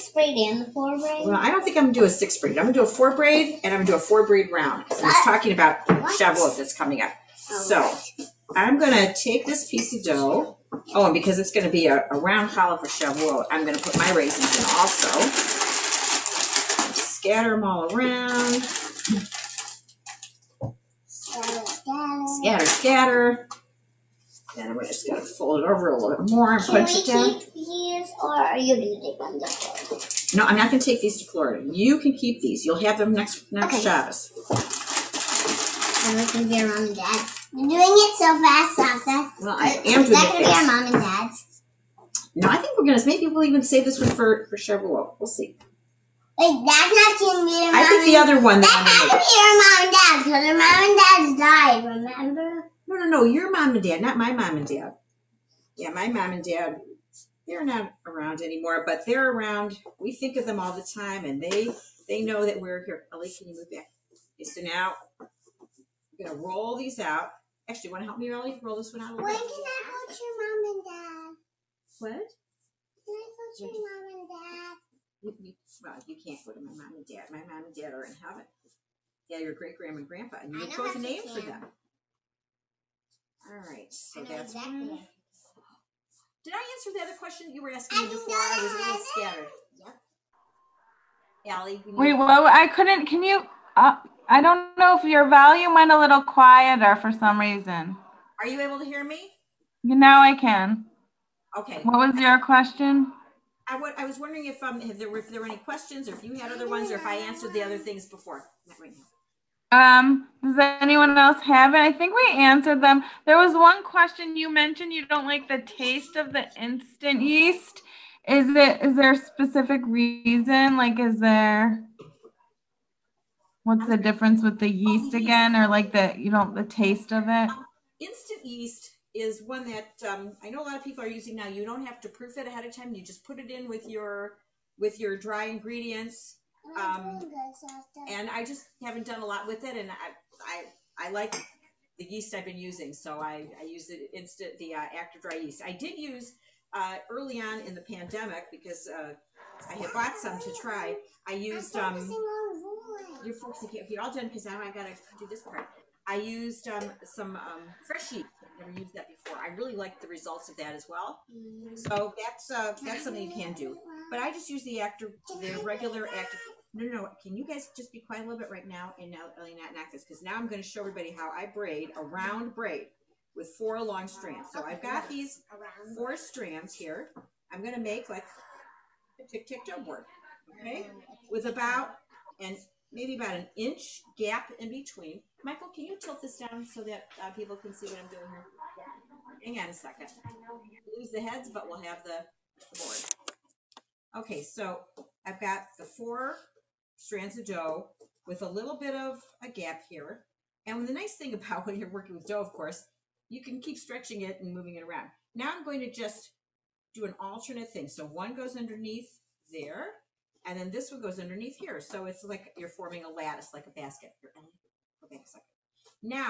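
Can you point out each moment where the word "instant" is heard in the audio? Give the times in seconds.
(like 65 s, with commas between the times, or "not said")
116 s, 127 s, 144 s.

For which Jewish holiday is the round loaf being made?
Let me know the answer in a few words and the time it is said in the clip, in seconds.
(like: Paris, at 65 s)
Shavuot, at 12 s.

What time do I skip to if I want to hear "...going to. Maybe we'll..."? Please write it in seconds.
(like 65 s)
42 s.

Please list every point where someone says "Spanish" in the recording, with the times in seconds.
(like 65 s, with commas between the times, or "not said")
not said.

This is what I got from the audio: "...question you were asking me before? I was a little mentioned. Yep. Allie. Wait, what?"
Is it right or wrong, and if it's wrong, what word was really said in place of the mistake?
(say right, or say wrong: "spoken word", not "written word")
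wrong: "scattered", not "mentioned".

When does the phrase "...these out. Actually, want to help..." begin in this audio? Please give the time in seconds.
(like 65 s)
66 s.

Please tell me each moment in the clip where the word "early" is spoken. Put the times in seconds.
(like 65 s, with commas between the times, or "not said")
147 s.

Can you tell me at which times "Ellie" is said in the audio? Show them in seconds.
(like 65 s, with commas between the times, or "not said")
63 s.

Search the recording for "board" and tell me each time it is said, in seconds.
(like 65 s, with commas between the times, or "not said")
179 s, 192 s.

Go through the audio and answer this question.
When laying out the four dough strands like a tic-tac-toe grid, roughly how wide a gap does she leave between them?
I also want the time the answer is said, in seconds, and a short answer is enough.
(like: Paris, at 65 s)
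About an inch, at 183 s.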